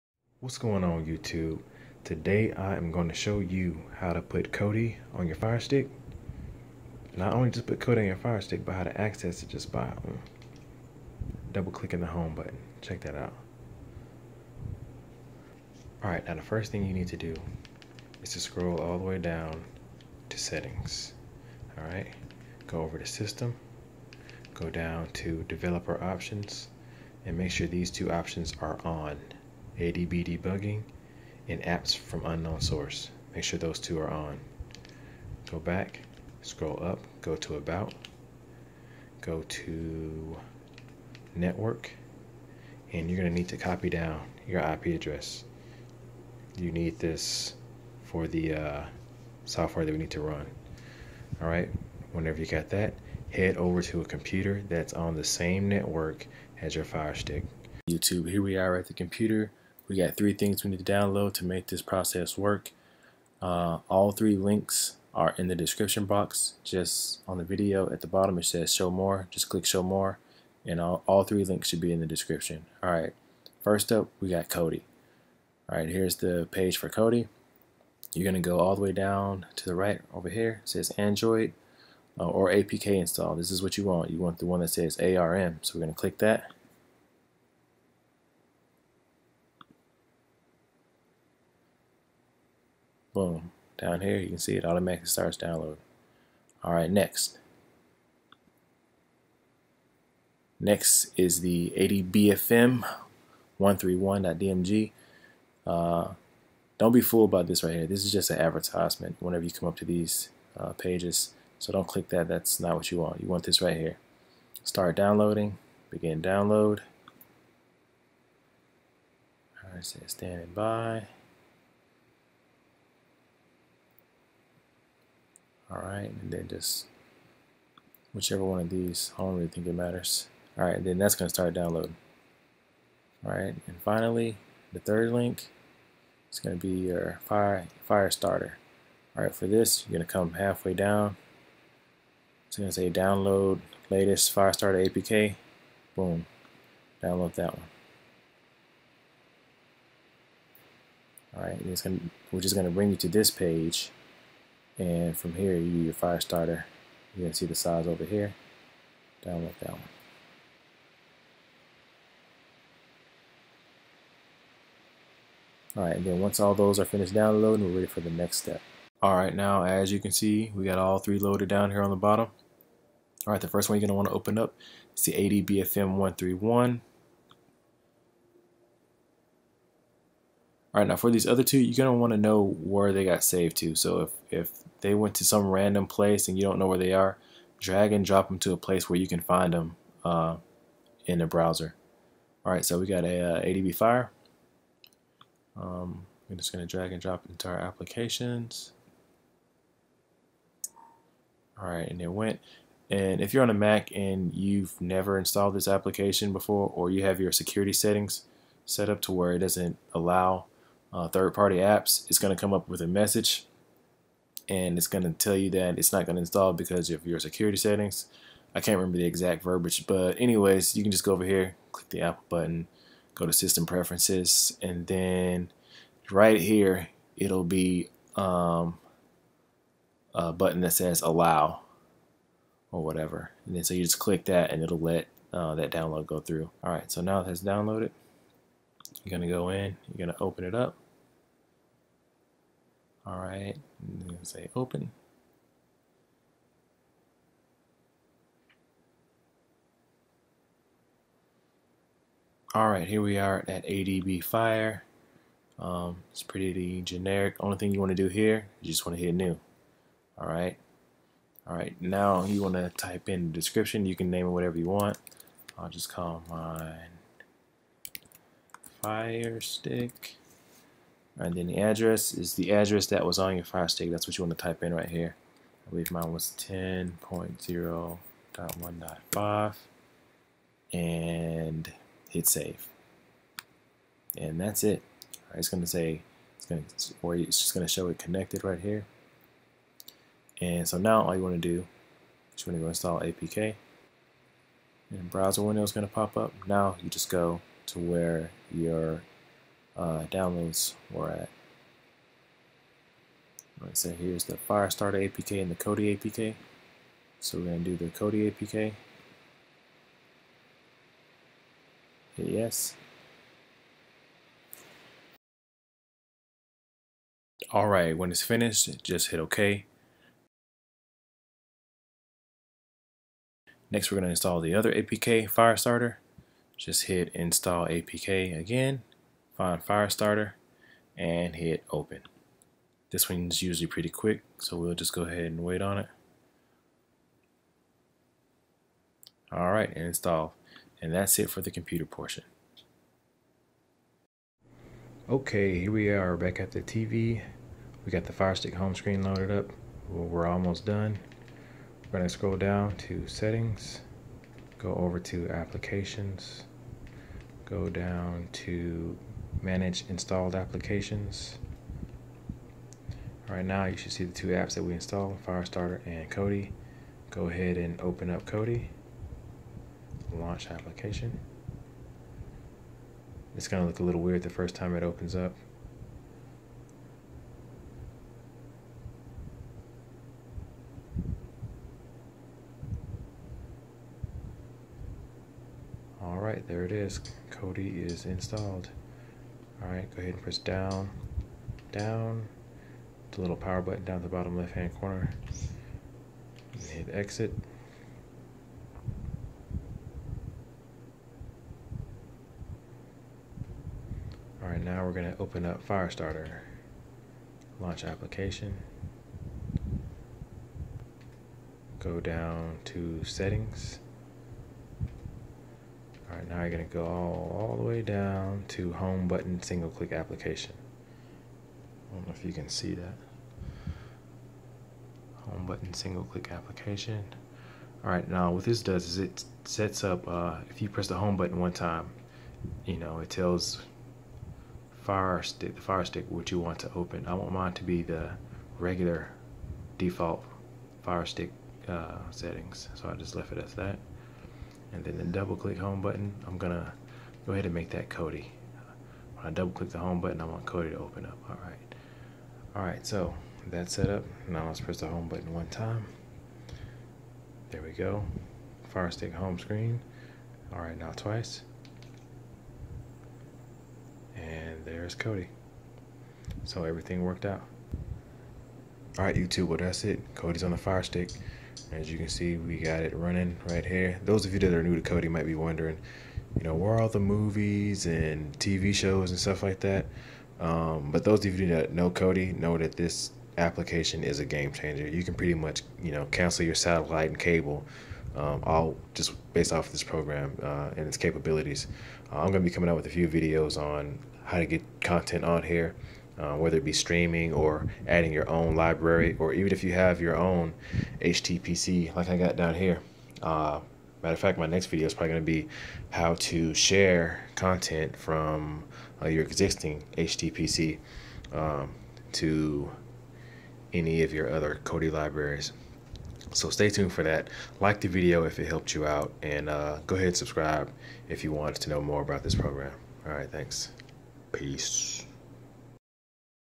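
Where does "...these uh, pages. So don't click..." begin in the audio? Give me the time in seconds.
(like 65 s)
109 s.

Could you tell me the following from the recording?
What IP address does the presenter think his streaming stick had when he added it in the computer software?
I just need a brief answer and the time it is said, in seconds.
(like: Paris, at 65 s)
10.0.1.5, at 276 s.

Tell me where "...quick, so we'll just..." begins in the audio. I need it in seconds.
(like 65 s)
333 s.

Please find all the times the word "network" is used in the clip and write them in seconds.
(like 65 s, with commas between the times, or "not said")
41 s, 55 s.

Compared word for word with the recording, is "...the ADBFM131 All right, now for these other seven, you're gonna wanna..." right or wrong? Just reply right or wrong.
wrong.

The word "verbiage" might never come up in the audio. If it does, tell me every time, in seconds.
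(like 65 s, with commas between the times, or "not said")
219 s.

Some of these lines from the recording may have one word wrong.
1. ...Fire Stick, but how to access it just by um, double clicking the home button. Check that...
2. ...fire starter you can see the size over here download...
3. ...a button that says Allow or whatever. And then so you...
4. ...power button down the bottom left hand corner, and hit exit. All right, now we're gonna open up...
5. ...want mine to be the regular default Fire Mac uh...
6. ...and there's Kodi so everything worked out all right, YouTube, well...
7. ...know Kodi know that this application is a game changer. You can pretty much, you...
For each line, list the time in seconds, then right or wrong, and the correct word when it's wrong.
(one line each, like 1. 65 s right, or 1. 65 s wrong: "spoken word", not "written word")
1. 8 s right
2. 155 s right
3. 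230 s right
4. 393 s right
5. 437 s wrong: "Stick", not "Mac"
6. 464 s right
7. 481 s right.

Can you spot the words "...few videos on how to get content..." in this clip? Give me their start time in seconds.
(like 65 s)
492 s.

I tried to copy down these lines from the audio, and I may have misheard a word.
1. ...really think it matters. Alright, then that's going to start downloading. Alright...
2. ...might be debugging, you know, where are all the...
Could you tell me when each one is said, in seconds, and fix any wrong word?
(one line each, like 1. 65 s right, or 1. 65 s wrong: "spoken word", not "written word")
1. 129 s right
2. 475 s wrong: "wondering", not "debugging".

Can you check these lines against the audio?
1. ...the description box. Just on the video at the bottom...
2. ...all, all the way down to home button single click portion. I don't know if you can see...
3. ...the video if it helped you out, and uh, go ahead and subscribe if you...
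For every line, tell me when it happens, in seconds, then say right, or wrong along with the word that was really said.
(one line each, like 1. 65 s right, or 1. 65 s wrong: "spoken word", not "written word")
1. 65 s right
2. 416 s wrong: "application", not "portion"
3. 517 s right.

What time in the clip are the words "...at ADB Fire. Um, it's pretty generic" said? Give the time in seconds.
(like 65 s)
253 s.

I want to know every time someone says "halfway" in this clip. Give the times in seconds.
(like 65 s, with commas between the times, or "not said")
140 s.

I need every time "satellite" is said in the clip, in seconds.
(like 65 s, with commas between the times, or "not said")
486 s.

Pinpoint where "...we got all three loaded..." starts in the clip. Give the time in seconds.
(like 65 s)
170 s.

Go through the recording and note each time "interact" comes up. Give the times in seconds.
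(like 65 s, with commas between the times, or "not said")
not said.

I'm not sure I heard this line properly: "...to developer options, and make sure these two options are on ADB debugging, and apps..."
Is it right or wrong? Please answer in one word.
right.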